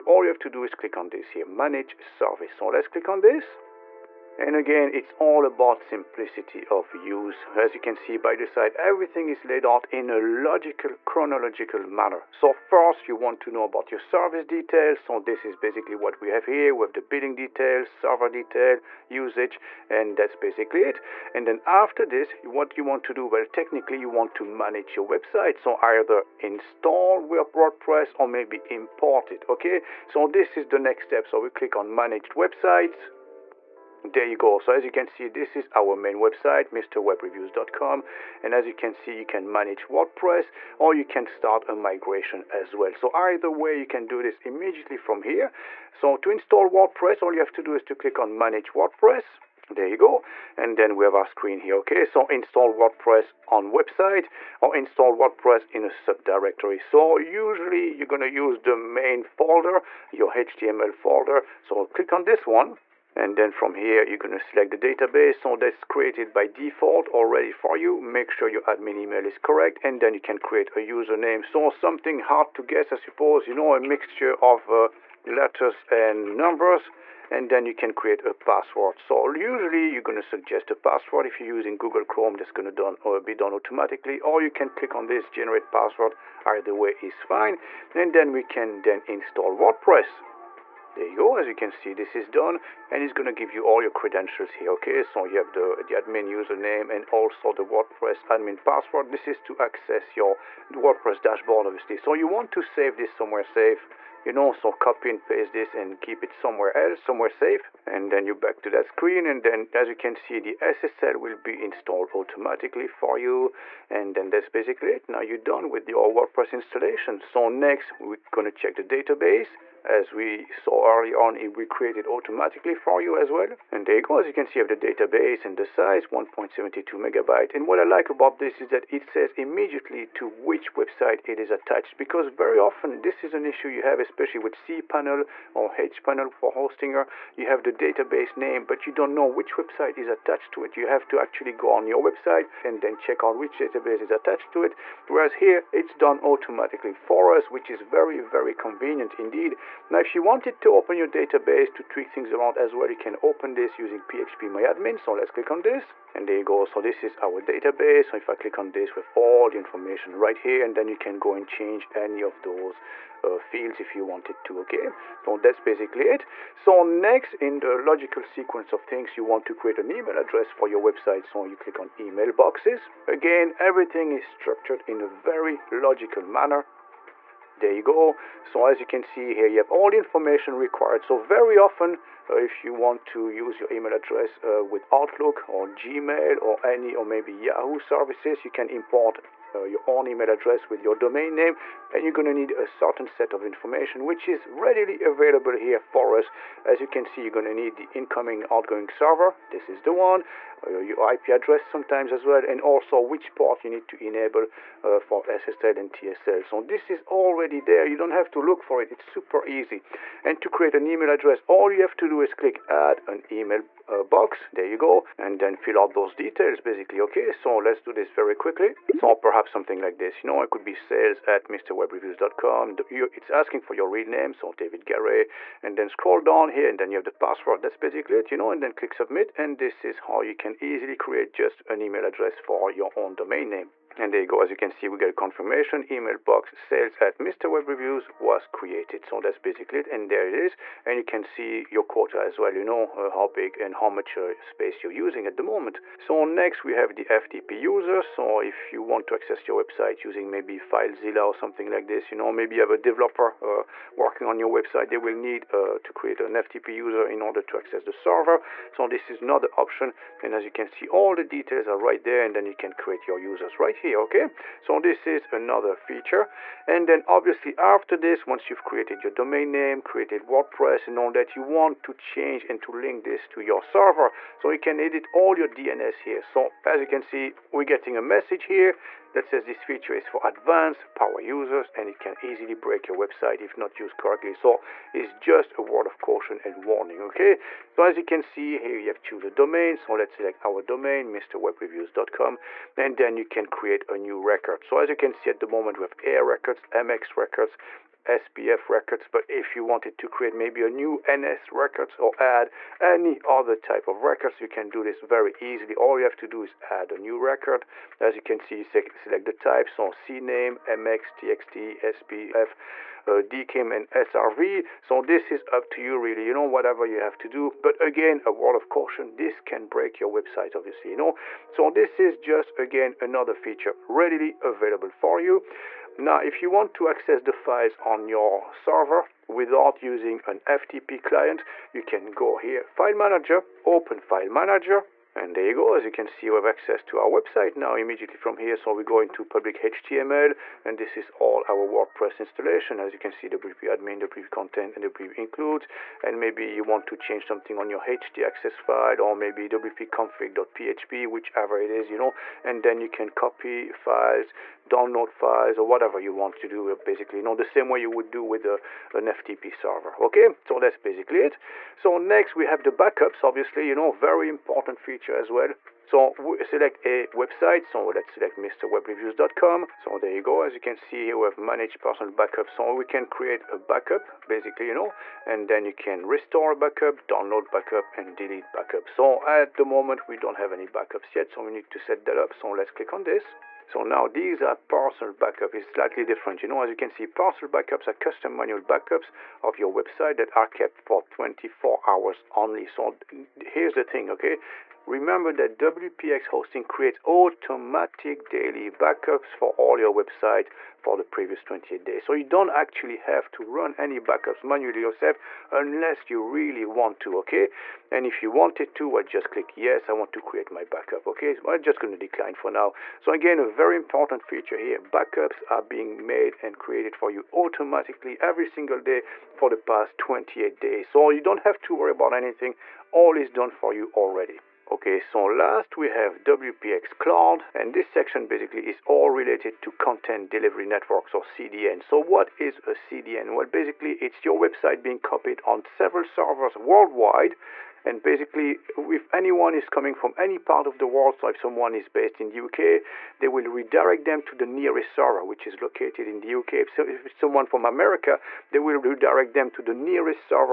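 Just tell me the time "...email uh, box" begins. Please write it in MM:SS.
03:33.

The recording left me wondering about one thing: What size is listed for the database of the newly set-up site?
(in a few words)
1.72 megabyte.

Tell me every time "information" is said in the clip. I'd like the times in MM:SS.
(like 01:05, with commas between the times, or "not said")
02:39, 02:59, 03:13.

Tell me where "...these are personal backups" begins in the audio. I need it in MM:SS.
06:24.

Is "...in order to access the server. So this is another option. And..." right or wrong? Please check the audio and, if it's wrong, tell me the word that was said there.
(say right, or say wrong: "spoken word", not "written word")
right.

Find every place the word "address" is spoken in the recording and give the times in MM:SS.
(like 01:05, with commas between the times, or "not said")
02:50, 03:03, 03:10, 03:21, 03:31, 03:52.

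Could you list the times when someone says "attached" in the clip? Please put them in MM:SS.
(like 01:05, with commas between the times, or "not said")
02:11, 02:20, 02:24.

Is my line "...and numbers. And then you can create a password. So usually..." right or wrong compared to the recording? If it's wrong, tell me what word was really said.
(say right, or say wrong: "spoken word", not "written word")
right.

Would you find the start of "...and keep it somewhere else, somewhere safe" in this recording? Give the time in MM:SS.
01:45.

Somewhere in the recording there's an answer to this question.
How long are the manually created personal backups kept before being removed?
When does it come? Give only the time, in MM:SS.
06:31.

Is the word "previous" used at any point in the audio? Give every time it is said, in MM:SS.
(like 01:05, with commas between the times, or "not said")
06:41.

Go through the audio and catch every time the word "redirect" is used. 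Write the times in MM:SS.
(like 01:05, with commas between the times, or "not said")
07:23, 07:28.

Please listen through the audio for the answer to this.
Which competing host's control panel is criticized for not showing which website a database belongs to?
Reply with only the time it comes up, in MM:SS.
02:16.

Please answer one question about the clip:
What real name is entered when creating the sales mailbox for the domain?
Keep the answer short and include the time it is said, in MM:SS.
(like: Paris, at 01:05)
David Gary, at 03:44.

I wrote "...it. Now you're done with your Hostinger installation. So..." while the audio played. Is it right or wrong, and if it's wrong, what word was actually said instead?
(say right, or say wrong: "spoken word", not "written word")
wrong: "WordPress", not "Hostinger".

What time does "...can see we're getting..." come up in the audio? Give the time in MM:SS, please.
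04:36.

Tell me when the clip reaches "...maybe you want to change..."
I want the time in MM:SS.
05:46.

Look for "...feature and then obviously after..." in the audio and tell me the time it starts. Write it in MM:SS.
04:25.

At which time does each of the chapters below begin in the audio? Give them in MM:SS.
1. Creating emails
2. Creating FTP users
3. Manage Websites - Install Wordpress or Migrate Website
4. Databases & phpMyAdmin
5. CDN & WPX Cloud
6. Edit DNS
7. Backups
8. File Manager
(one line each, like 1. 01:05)
1. 02:50
2. 04:09
3. 00:24
4. 02:00
5. 07:07
6. 04:35
7. 05:59
8. 05:29.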